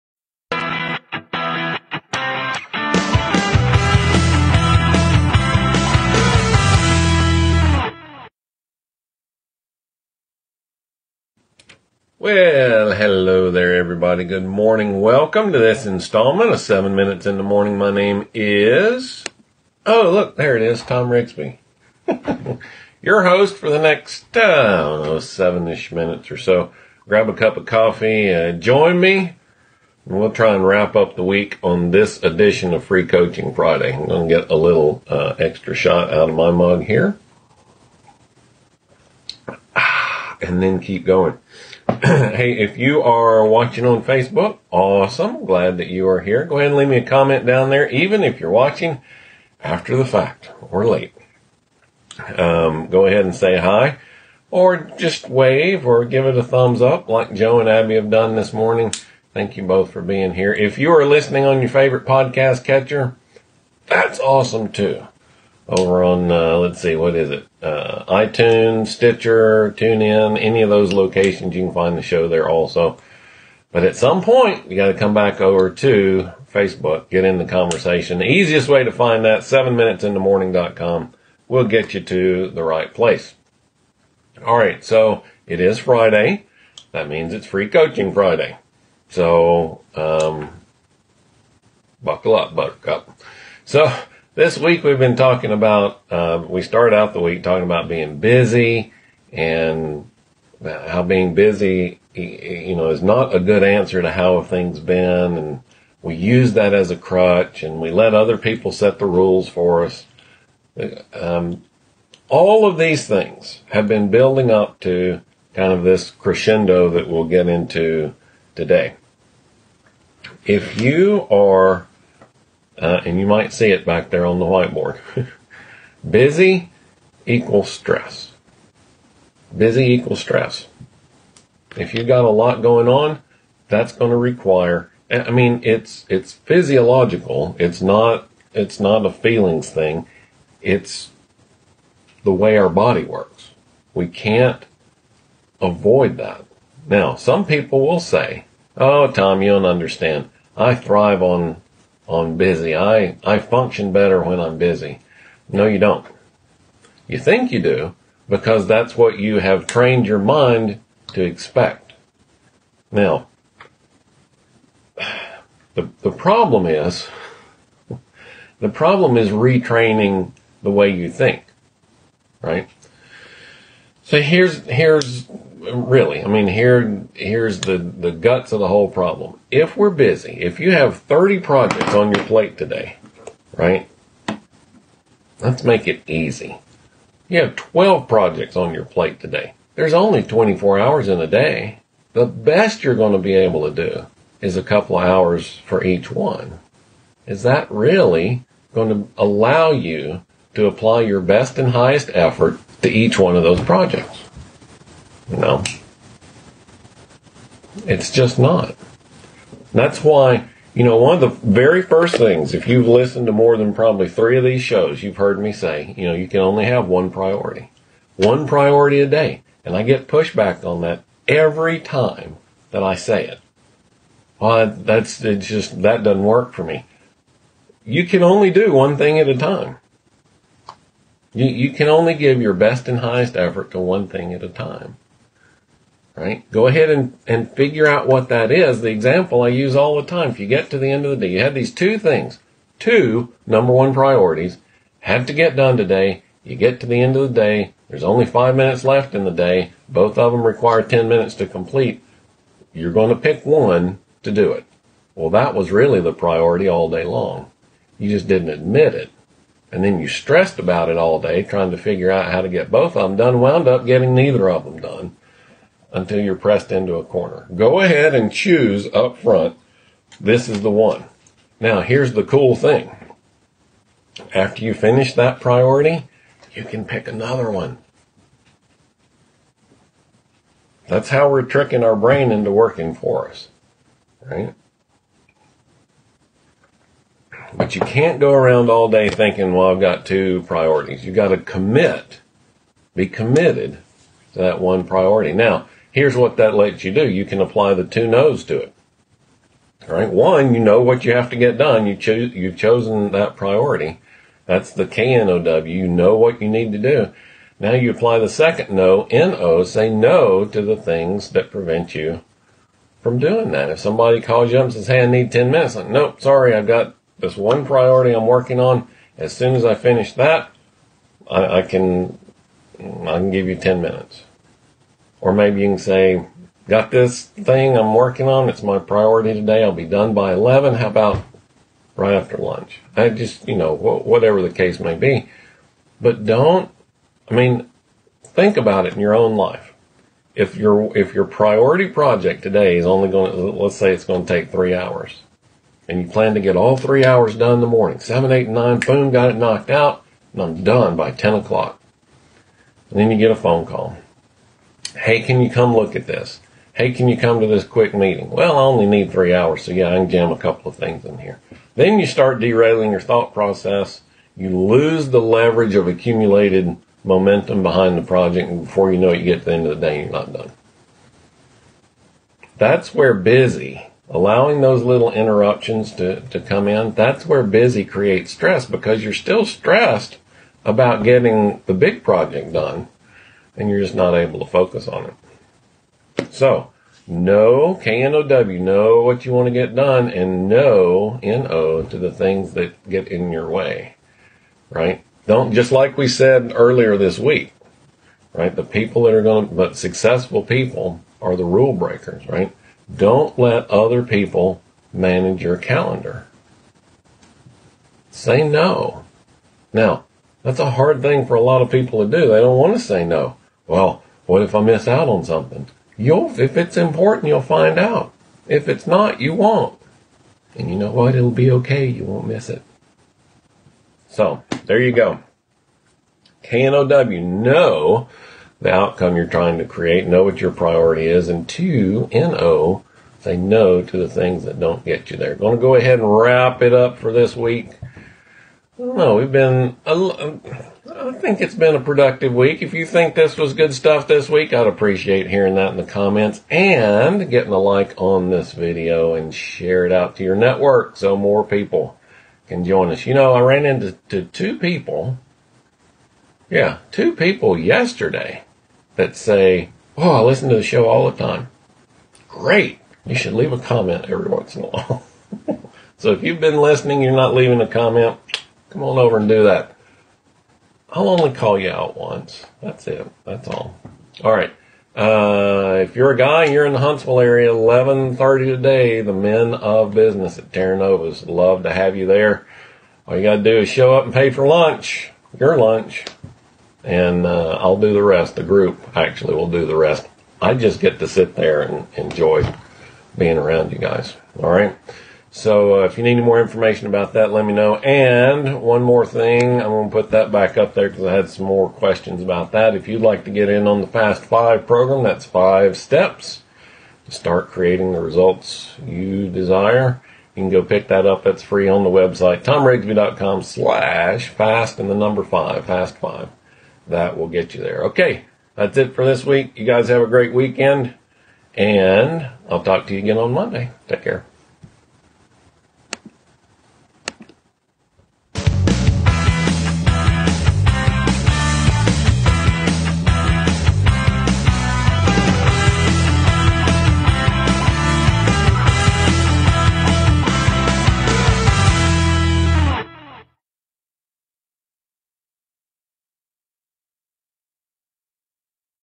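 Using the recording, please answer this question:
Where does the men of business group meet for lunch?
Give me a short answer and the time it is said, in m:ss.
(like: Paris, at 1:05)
Terra Nova's, at 8:00.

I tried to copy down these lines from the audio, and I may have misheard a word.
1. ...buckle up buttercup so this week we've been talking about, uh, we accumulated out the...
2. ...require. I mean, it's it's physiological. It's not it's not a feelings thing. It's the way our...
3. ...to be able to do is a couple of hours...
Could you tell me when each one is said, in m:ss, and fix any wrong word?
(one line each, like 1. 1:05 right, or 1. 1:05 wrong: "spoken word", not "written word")
1. 1:32 wrong: "started", not "accumulated"
2. 2:14 right
3. 3:13 right.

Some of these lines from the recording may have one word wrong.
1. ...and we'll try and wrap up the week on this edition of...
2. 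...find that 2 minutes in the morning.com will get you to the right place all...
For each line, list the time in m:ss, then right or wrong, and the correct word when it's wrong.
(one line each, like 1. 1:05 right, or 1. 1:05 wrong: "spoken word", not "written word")
1. 0:30 right
2. 1:18 wrong: "7", not "2".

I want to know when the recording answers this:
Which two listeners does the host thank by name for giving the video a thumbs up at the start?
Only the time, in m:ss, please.
0:57.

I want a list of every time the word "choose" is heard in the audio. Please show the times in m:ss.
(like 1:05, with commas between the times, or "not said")
4:28, 5:01.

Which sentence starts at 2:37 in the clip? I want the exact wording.
You think you do because that's what you have trained your mind to expect.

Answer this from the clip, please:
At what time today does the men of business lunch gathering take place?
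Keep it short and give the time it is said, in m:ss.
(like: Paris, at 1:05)
11:30, at 7:57.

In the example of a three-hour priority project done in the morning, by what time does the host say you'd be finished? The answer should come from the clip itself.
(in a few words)
10 o'clock.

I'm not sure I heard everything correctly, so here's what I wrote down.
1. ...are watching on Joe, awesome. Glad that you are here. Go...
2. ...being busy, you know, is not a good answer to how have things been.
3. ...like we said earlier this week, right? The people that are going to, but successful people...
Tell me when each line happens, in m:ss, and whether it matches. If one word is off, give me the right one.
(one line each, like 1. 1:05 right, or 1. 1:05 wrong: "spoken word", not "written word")
1. 0:43 wrong: "Facebook", not "Joe"
2. 1:41 right
3. 6:35 right.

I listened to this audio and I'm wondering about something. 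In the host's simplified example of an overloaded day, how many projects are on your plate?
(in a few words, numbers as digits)
12.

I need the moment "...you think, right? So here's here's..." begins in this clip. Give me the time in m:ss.
2:50.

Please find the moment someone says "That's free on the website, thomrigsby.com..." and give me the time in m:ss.
8:31.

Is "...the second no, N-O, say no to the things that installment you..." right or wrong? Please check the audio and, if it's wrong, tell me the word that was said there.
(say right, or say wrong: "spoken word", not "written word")
wrong: "prevent", not "installment".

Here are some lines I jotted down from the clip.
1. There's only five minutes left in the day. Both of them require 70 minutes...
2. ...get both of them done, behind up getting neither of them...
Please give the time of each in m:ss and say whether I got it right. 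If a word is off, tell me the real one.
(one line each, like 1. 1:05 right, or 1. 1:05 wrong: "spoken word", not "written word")
1. 4:07 wrong: "10", not "70"
2. 4:22 wrong: "wound", not "behind".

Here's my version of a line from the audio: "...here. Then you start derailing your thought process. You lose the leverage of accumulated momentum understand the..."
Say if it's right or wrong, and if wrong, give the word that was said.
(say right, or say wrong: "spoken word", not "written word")
wrong: "behind", not "understand".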